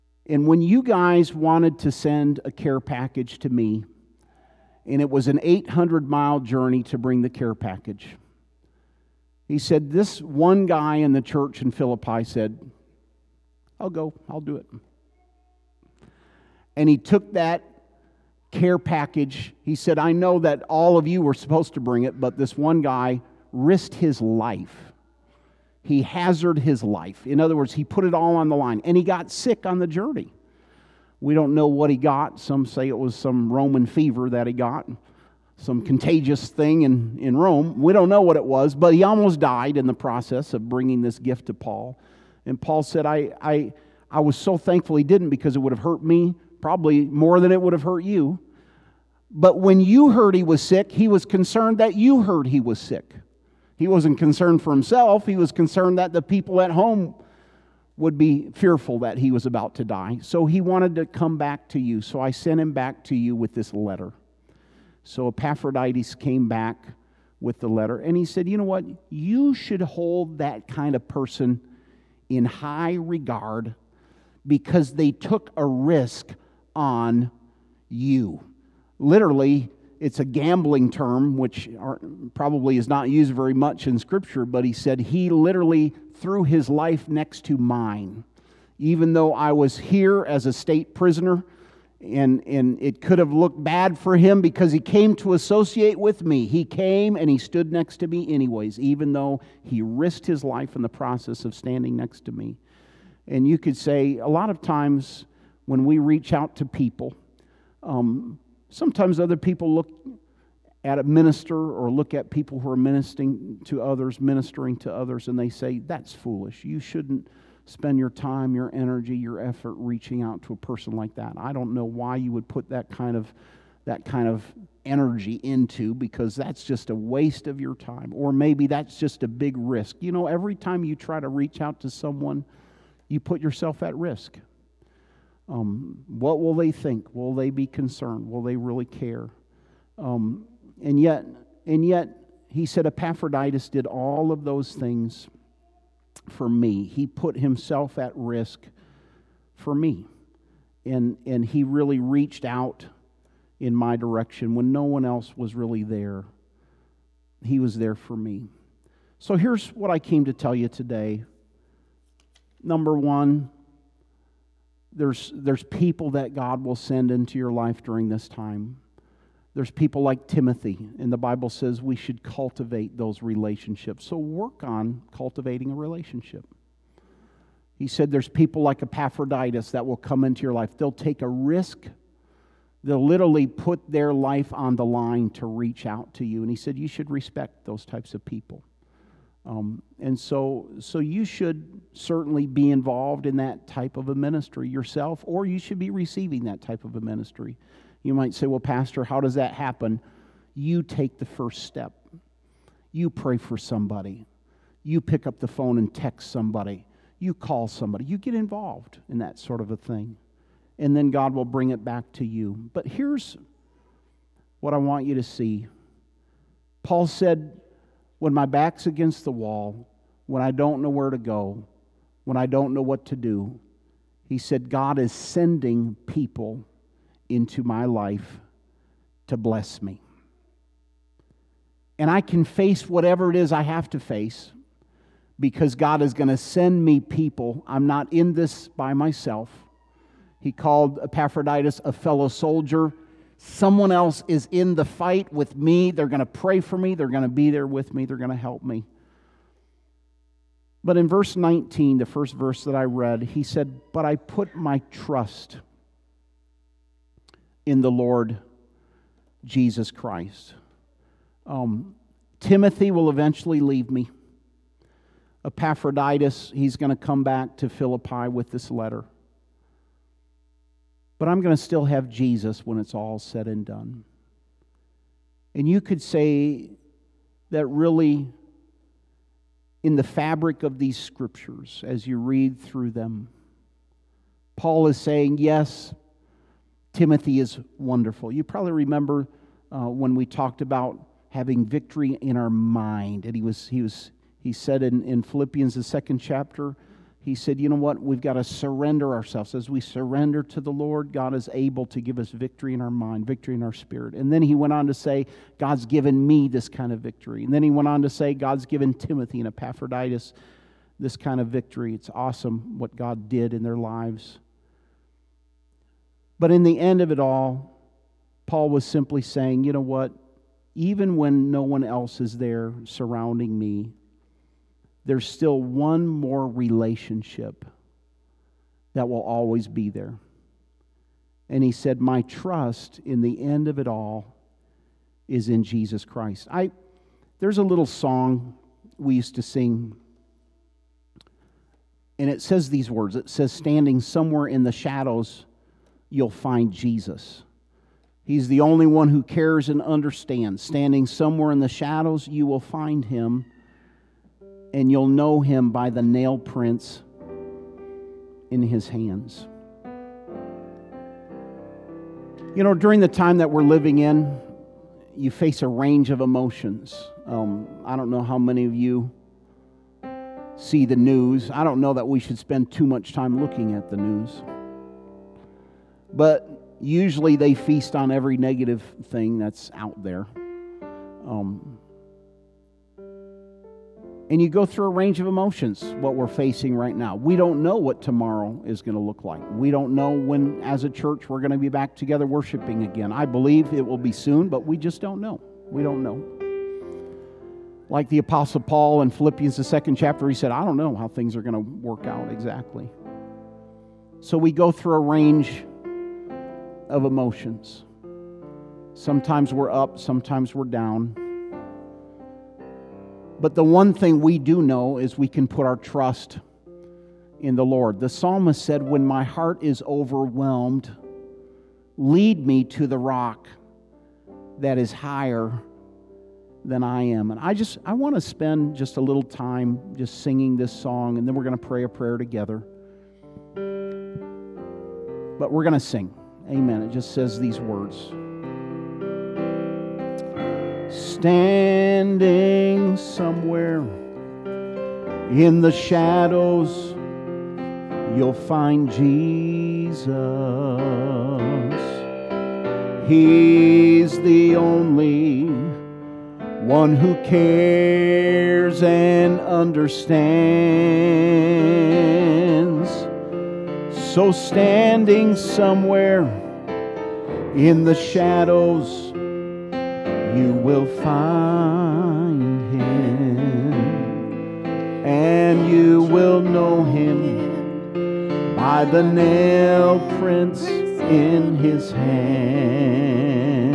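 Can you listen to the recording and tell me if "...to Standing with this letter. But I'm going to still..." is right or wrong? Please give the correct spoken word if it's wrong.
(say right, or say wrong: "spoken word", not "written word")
wrong: "Philippi", not "Standing".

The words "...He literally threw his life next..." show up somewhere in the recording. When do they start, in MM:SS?
01:24.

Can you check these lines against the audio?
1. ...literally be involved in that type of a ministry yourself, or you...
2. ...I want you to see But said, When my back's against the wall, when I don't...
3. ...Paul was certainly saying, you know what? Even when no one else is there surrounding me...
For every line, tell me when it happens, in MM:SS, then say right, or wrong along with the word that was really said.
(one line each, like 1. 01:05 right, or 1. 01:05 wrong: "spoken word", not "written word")
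1. 03:11 wrong: "certainly", not "literally"
2. 03:34 wrong: "Paul", not "But"
3. 05:18 wrong: "simply", not "certainly".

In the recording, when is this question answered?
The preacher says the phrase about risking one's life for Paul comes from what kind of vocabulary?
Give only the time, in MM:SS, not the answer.
01:20.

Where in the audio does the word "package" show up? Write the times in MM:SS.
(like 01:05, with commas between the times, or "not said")
00:02, 00:07, 00:18.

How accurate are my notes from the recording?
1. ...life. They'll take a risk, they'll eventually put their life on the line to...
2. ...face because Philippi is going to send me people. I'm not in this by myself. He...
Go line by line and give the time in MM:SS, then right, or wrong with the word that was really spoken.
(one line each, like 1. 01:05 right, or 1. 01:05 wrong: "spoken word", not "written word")
1. 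03:00 wrong: "literally", not "eventually"
2. 03:53 wrong: "God", not "Philippi".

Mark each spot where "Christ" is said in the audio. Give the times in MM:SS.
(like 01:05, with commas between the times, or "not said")
04:19, 05:36.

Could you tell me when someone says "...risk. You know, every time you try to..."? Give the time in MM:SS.
02:09.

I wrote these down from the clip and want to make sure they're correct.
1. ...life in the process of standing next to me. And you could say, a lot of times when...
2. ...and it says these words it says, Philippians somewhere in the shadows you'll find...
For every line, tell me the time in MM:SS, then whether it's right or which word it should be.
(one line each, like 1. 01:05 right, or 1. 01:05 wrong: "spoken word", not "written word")
1. 01:40 right
2. 05:42 wrong: "Standing", not "Philippians".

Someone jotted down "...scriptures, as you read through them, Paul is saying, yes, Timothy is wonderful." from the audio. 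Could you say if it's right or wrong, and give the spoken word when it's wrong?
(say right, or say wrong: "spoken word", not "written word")
right.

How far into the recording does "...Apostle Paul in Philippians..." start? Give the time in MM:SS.
06:38.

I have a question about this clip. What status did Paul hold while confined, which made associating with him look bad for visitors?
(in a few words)
state prisoner.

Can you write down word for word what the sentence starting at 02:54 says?
So work on cultivating a relationship.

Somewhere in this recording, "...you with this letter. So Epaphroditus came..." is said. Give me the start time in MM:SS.
01:03.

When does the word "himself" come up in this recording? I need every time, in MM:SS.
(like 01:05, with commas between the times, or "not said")
00:54, 02:27.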